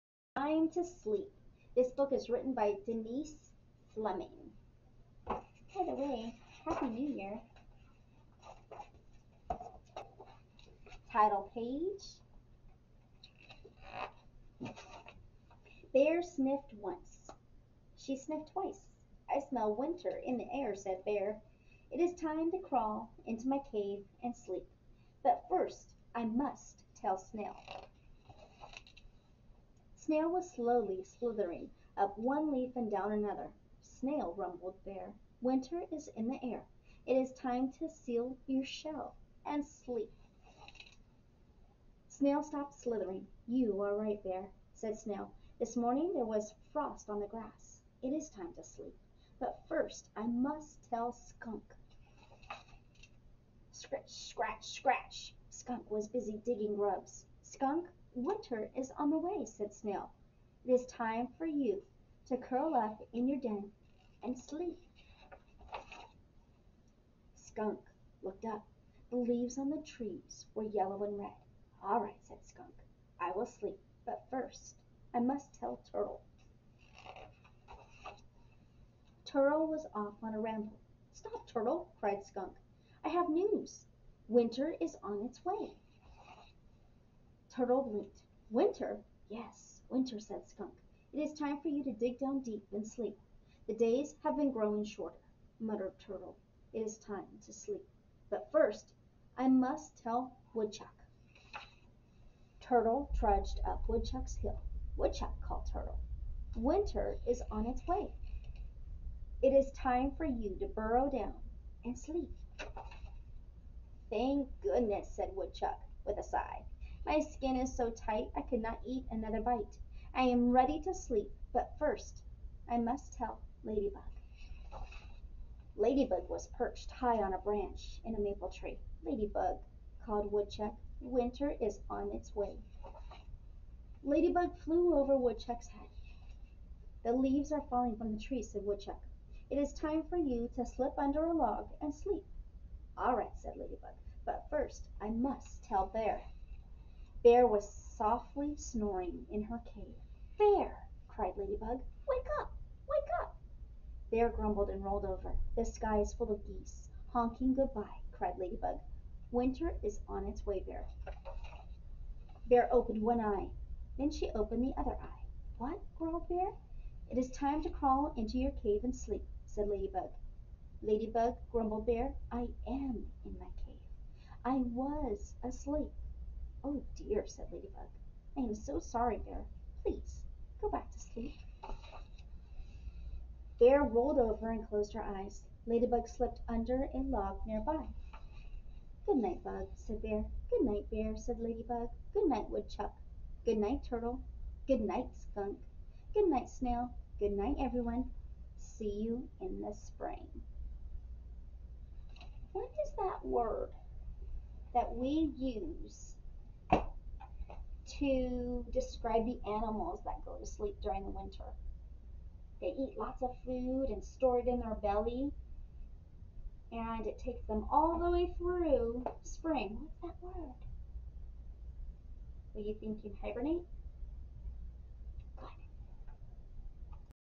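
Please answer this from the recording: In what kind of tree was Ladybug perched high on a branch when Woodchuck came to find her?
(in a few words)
Maple.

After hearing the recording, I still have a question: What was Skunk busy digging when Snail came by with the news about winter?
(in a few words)
Grubs.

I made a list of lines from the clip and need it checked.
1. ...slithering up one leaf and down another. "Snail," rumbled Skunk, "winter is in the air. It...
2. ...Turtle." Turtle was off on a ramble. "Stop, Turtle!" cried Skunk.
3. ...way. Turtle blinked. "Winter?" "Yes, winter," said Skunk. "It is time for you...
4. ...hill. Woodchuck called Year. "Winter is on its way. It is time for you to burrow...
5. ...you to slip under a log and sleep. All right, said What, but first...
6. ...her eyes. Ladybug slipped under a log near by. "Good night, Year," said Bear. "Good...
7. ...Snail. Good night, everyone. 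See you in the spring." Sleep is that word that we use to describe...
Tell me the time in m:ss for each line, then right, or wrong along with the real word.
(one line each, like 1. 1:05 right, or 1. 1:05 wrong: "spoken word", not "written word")
1. 0:31 wrong: "Bear", not "Skunk"
2. 1:15 right
3. 1:25 right
4. 1:44 wrong: "Turtle", not "Year"
5. 2:20 wrong: "Ladybug", not "What"
6. 3:04 wrong: "Bug", not "Year"
7. 3:16 wrong: "What", not "Sleep".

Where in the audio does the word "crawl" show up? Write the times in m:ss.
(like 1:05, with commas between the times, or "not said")
0:22, 2:47.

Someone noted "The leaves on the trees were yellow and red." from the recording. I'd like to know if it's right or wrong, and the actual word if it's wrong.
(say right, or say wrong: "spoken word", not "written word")
right.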